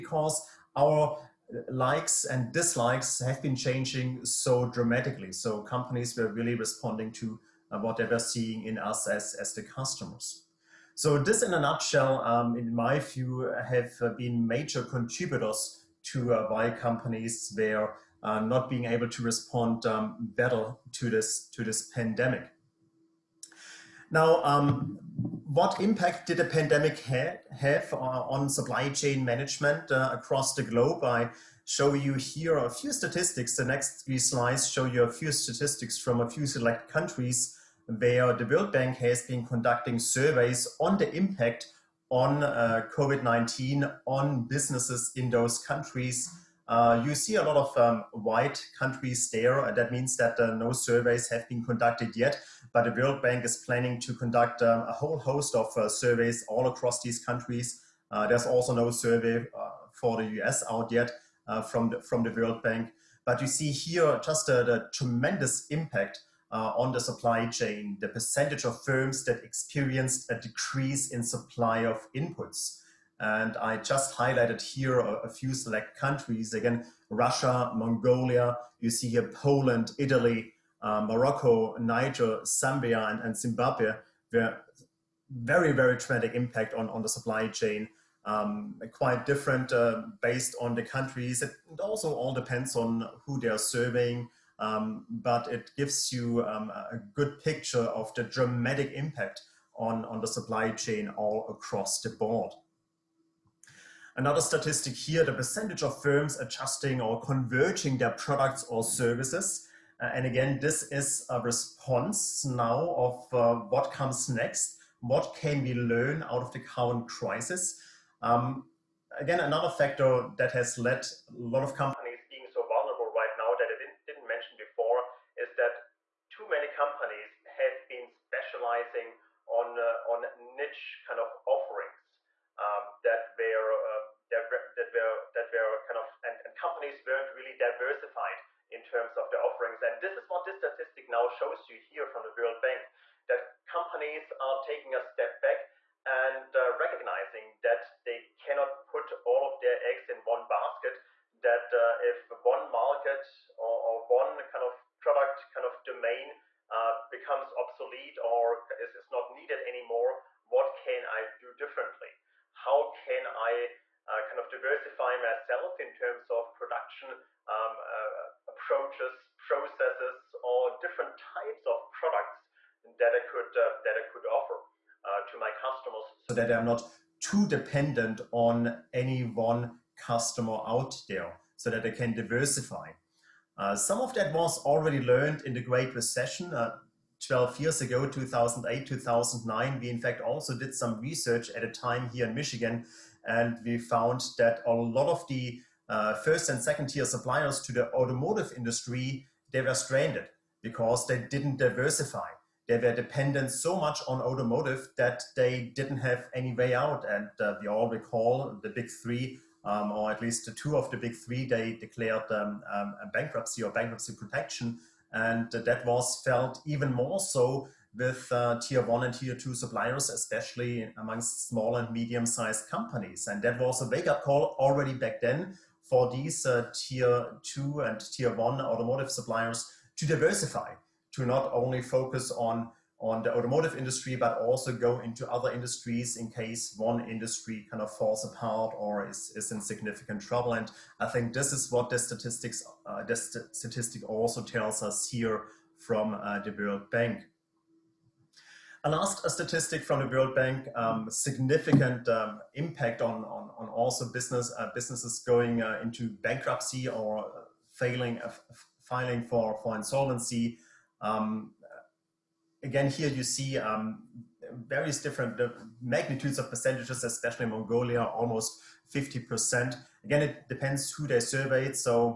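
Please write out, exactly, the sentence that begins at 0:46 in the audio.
Uh, you see a lot of um, white countries there.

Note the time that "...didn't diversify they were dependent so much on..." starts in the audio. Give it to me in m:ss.
3:21.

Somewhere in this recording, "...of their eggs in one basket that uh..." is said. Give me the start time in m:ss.
2:29.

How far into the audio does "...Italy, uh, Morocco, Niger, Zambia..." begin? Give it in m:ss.
1:19.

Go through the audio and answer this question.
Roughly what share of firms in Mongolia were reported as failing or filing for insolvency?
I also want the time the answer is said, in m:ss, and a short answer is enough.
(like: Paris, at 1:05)
almost 50%, at 4:28.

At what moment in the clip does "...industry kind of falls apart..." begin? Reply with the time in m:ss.
3:57.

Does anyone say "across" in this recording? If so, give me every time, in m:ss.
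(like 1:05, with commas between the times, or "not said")
0:30, 0:56, 1:41.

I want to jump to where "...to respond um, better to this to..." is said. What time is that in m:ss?
0:19.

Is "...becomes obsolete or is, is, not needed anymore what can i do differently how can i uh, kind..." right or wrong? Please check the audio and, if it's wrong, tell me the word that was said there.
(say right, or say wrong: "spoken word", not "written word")
right.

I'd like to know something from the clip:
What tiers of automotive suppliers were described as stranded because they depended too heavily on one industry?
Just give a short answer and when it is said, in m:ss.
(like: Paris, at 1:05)
first and second tier, at 3:16.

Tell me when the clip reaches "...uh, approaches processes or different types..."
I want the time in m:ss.
2:47.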